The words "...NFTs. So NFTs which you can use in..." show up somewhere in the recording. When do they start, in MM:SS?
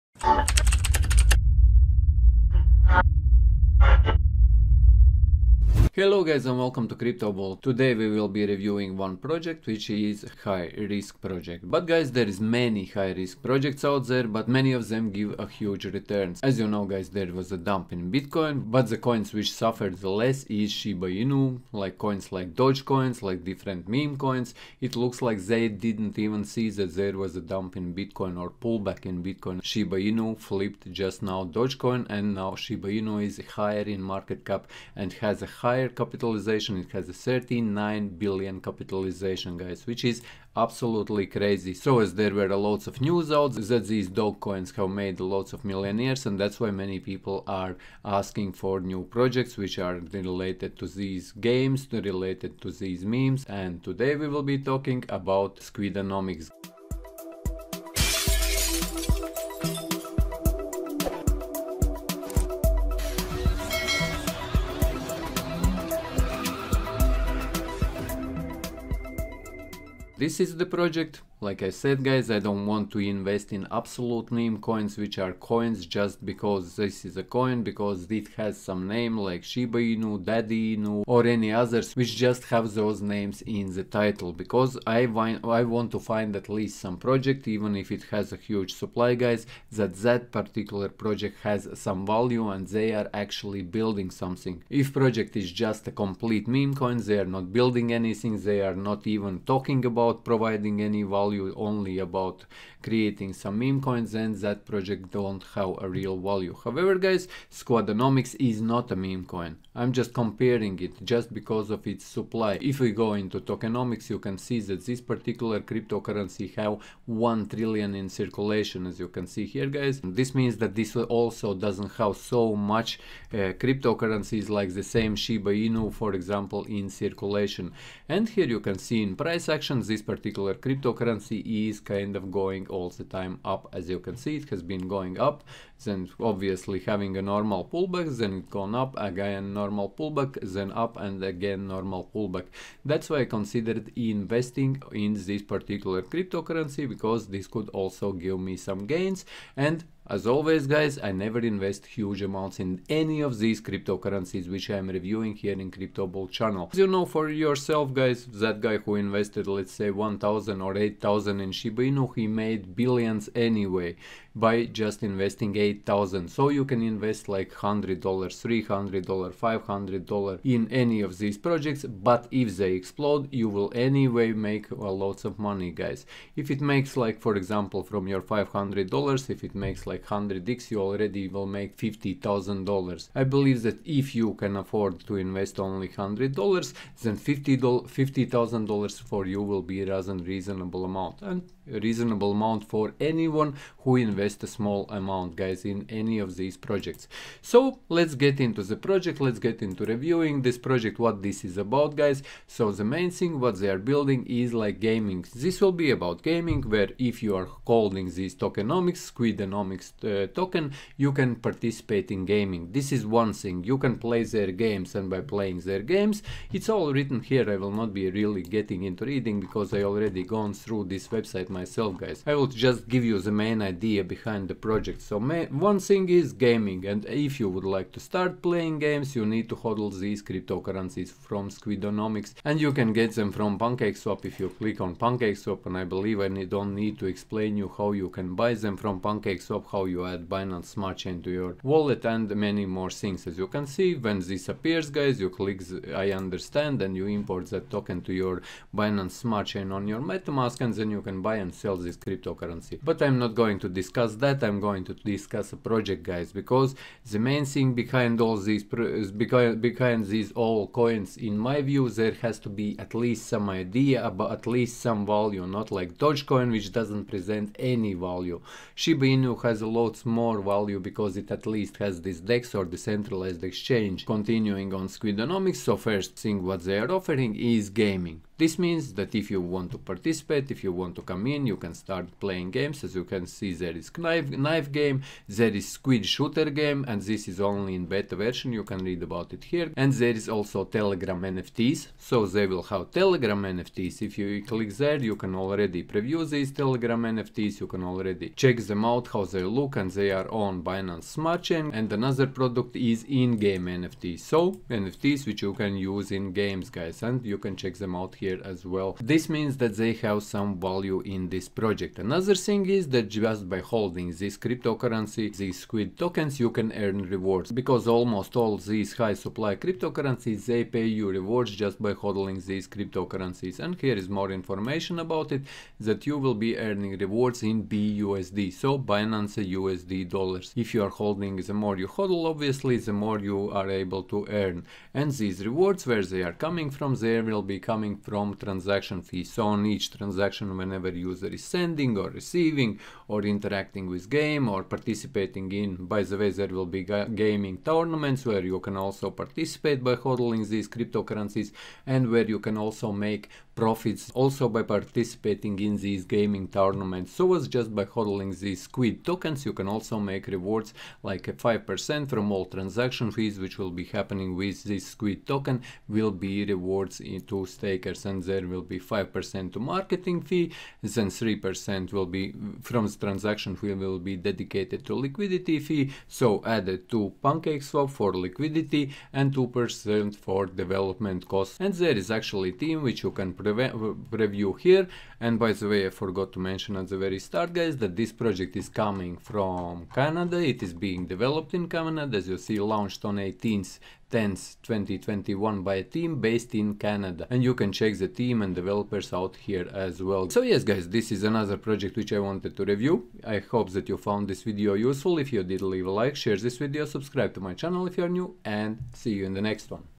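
05:03.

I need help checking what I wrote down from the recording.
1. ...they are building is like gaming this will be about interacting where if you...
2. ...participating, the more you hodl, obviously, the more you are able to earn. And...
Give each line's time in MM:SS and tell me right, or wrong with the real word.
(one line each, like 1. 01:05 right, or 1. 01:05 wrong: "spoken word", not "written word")
1. 03:23 wrong: "gaming", not "interacting"
2. 05:31 wrong: "holding", not "participating".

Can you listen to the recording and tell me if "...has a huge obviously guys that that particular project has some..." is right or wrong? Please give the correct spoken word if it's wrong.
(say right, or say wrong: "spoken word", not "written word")
wrong: "supply", not "obviously".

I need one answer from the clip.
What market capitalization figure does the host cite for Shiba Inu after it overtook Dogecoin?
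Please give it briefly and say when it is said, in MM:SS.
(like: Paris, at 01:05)
39 billion, at 00:37.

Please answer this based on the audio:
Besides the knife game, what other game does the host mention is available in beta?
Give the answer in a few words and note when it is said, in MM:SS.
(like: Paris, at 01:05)
squid shooter, at 04:45.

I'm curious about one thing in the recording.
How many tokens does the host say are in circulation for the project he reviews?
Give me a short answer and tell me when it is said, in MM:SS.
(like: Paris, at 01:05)
1 trillion, at 01:57.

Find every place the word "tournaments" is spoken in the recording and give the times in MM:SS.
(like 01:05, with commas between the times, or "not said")
05:47, 05:56.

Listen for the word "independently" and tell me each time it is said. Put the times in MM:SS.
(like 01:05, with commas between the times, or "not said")
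not said.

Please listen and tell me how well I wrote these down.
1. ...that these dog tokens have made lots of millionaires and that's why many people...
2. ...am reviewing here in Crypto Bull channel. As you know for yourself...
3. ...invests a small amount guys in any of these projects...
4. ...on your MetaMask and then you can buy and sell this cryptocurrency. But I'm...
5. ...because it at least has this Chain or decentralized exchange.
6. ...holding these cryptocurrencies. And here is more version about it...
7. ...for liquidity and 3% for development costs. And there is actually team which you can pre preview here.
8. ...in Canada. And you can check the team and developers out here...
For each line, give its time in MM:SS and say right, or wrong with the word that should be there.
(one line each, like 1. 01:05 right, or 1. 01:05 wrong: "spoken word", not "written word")
1. 00:43 wrong: "coins", not "tokens"
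2. 02:34 right
3. 03:13 right
4. 04:09 right
5. 04:30 wrong: "DEX", not "Chain"
6. 05:22 wrong: "information", not "version"
7. 06:17 wrong: "2", not "3"
8. 06:36 right.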